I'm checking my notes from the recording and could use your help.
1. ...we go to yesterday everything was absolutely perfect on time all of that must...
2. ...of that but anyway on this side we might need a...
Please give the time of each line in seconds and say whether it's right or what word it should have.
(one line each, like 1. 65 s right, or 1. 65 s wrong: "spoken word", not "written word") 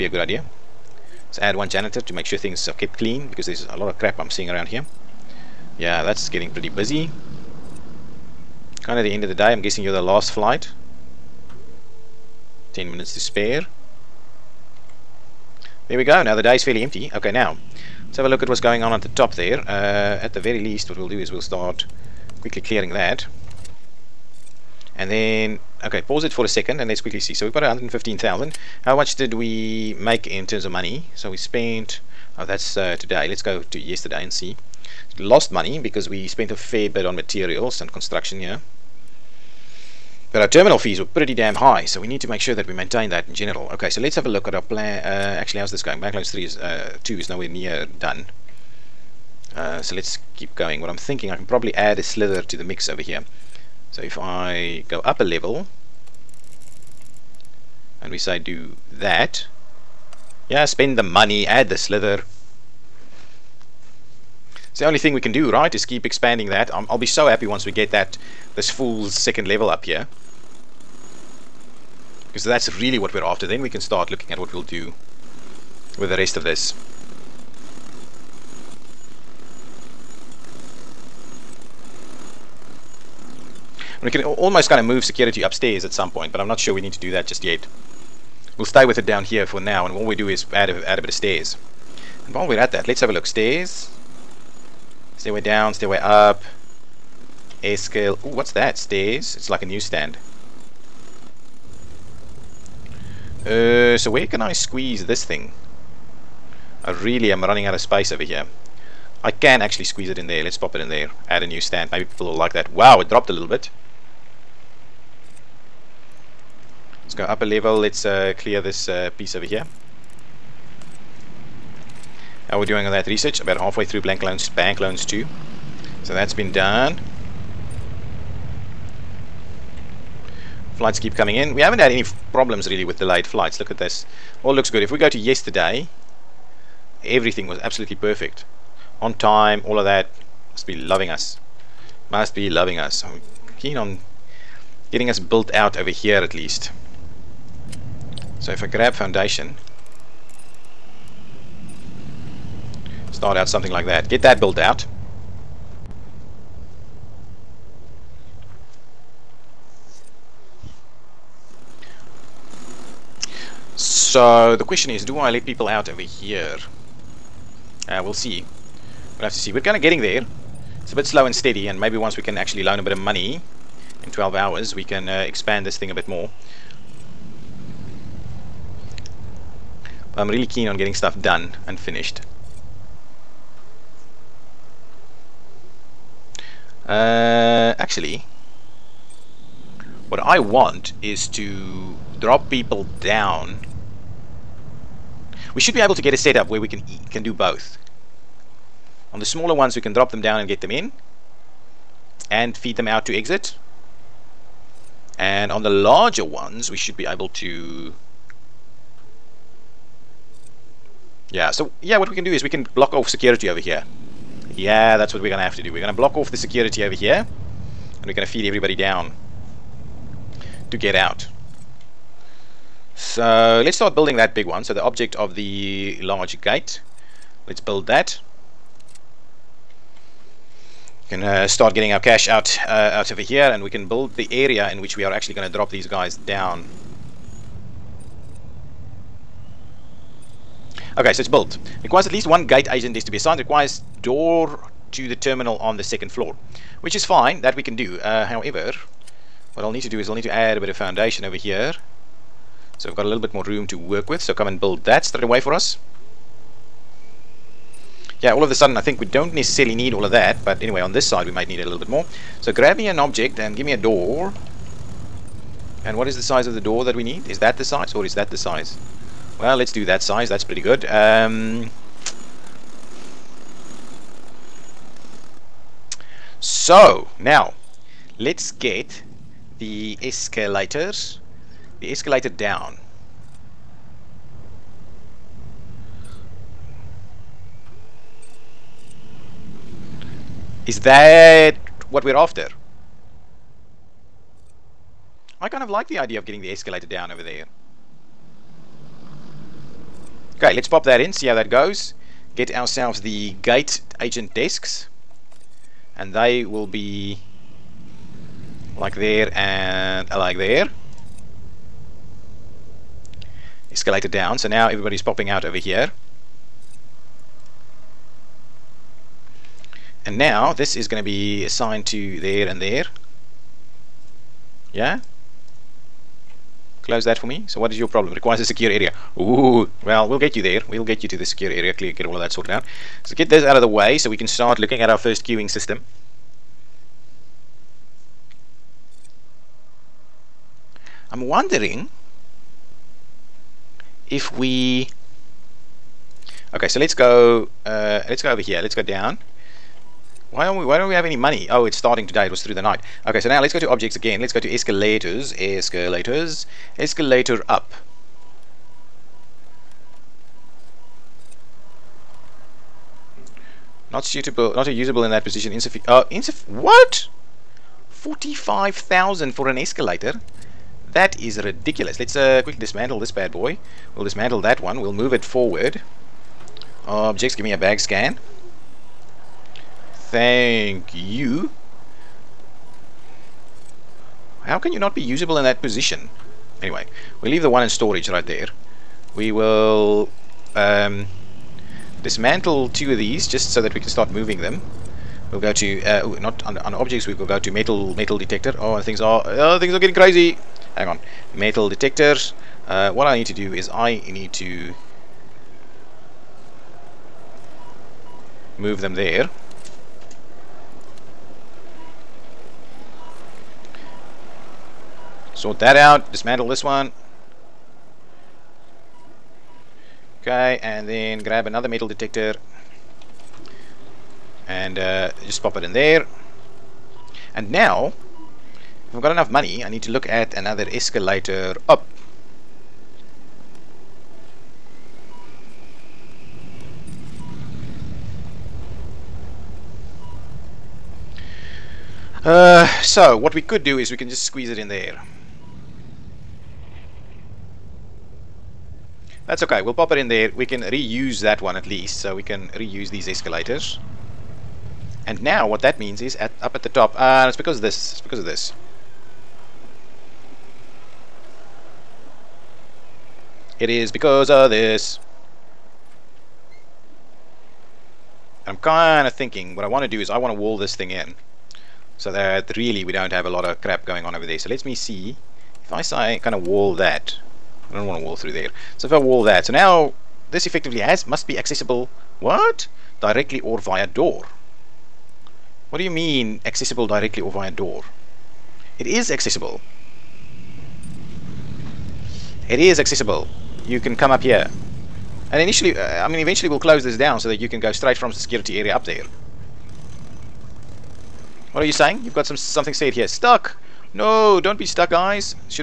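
1. 134 s right
2. 260 s right.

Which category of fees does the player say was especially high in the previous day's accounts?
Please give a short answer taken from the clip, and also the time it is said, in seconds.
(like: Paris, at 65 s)
terminal fees, at 40 s.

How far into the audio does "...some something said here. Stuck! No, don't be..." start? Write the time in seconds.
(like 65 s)
502 s.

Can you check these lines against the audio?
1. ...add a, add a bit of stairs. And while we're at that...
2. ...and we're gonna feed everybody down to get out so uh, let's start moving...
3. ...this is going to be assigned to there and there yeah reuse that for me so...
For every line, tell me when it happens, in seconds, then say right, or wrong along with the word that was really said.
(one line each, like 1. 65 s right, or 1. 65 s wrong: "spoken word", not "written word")
1. 90 s right
2. 218 s wrong: "building", not "moving"
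3. 320 s wrong: "close", not "reuse".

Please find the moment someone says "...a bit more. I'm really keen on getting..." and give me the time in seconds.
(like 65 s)
175 s.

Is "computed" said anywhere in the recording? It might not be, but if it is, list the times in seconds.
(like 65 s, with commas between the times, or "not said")
not said.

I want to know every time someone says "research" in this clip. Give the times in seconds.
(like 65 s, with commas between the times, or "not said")
123 s.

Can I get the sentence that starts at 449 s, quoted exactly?
That's okay, we'll pop it in there.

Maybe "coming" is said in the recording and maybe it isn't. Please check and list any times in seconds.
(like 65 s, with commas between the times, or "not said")
131 s.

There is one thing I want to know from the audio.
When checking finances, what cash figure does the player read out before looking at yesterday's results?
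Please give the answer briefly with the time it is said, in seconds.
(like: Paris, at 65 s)
115,000, at 27 s.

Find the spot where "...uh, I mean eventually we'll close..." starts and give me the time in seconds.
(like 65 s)
495 s.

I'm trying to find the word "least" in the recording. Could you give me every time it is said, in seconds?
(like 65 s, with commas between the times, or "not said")
20 s, 146 s, 242 s, 451 s.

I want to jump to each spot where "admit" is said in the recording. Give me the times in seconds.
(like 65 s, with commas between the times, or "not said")
not said.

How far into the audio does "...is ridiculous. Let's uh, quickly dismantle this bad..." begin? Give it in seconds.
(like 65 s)
371 s.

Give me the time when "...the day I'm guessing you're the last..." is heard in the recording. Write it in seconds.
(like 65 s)
9 s.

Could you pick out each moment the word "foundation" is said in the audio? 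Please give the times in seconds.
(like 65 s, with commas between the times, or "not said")
148 s, 250 s.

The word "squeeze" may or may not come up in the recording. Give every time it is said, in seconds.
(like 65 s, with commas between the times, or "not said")
104 s, 109 s, 444 s.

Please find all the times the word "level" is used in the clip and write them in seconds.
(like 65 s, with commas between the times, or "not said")
55 s, 69 s, 117 s.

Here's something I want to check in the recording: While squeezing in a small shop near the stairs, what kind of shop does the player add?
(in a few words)
newsstand.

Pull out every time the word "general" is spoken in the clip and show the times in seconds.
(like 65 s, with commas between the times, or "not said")
43 s.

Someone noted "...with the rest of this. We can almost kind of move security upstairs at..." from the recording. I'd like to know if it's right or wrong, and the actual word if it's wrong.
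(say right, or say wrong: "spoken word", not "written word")
right.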